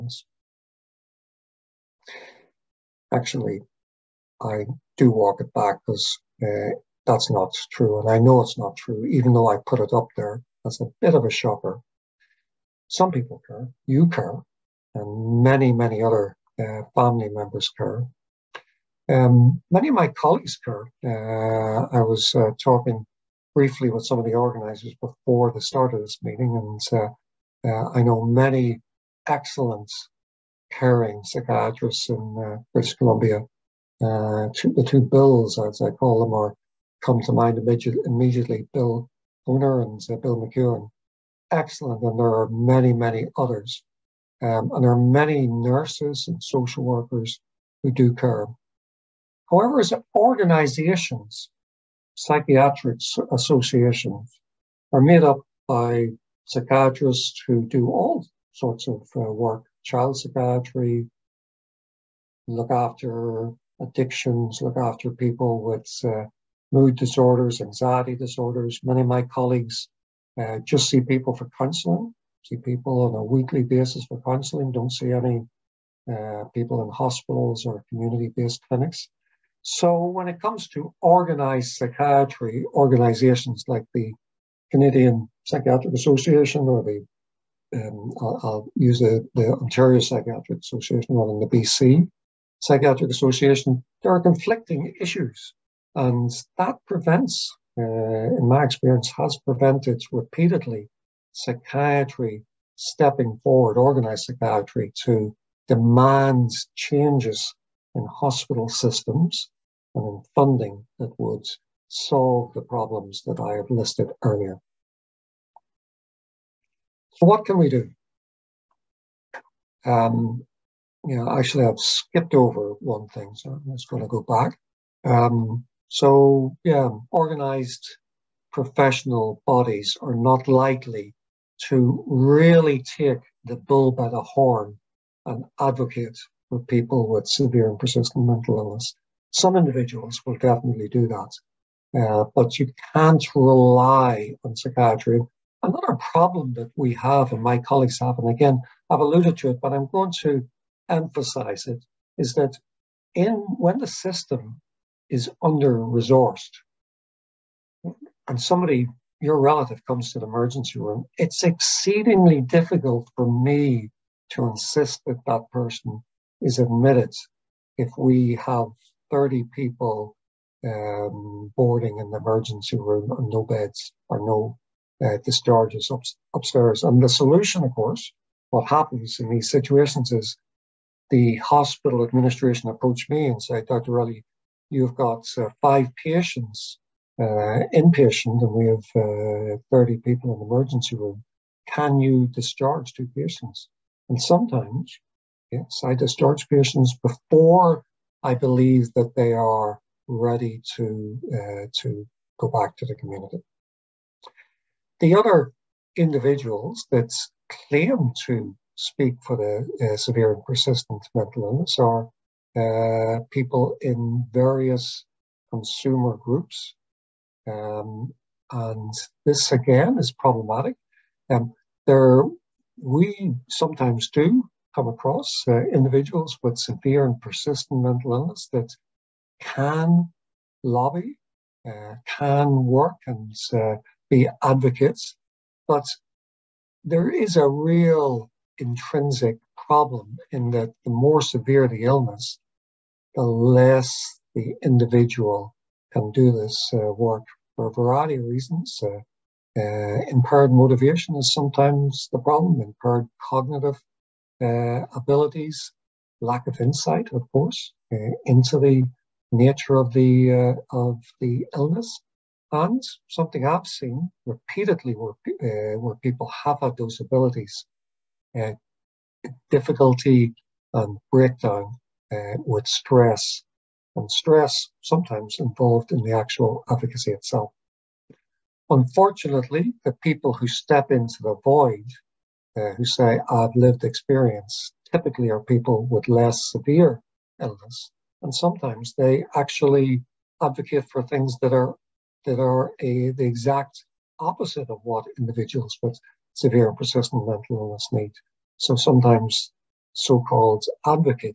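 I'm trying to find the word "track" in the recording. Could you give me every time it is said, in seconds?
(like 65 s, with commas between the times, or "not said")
not said.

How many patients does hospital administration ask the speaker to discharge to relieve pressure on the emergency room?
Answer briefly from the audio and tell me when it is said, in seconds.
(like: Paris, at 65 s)
2, at 192 s.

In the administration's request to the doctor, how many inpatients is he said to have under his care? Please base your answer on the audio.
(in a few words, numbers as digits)
5.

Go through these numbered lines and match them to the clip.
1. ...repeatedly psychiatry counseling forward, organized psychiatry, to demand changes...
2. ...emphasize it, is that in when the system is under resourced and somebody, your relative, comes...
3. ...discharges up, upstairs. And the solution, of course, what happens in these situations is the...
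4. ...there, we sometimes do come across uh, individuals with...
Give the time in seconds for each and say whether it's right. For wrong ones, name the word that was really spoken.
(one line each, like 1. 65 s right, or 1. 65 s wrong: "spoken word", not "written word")
1. 100 s wrong: "stepping", not "counseling"
2. 150 s right
3. 175 s right
4. 221 s right.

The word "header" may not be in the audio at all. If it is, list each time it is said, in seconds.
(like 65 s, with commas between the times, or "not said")
not said.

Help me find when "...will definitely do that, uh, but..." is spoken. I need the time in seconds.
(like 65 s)
140 s.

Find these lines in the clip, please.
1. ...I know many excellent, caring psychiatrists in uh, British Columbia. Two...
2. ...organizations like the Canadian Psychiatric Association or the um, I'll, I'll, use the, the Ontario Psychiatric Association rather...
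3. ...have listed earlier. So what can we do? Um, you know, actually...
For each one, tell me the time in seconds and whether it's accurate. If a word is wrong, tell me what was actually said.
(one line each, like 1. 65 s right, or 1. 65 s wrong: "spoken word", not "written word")
1. 27 s right
2. 82 s right
3. 113 s right.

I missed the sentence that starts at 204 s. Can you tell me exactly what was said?
The other individuals that claim to speak for the uh, severe and persistent mental illness are uh, people in various consumer groups.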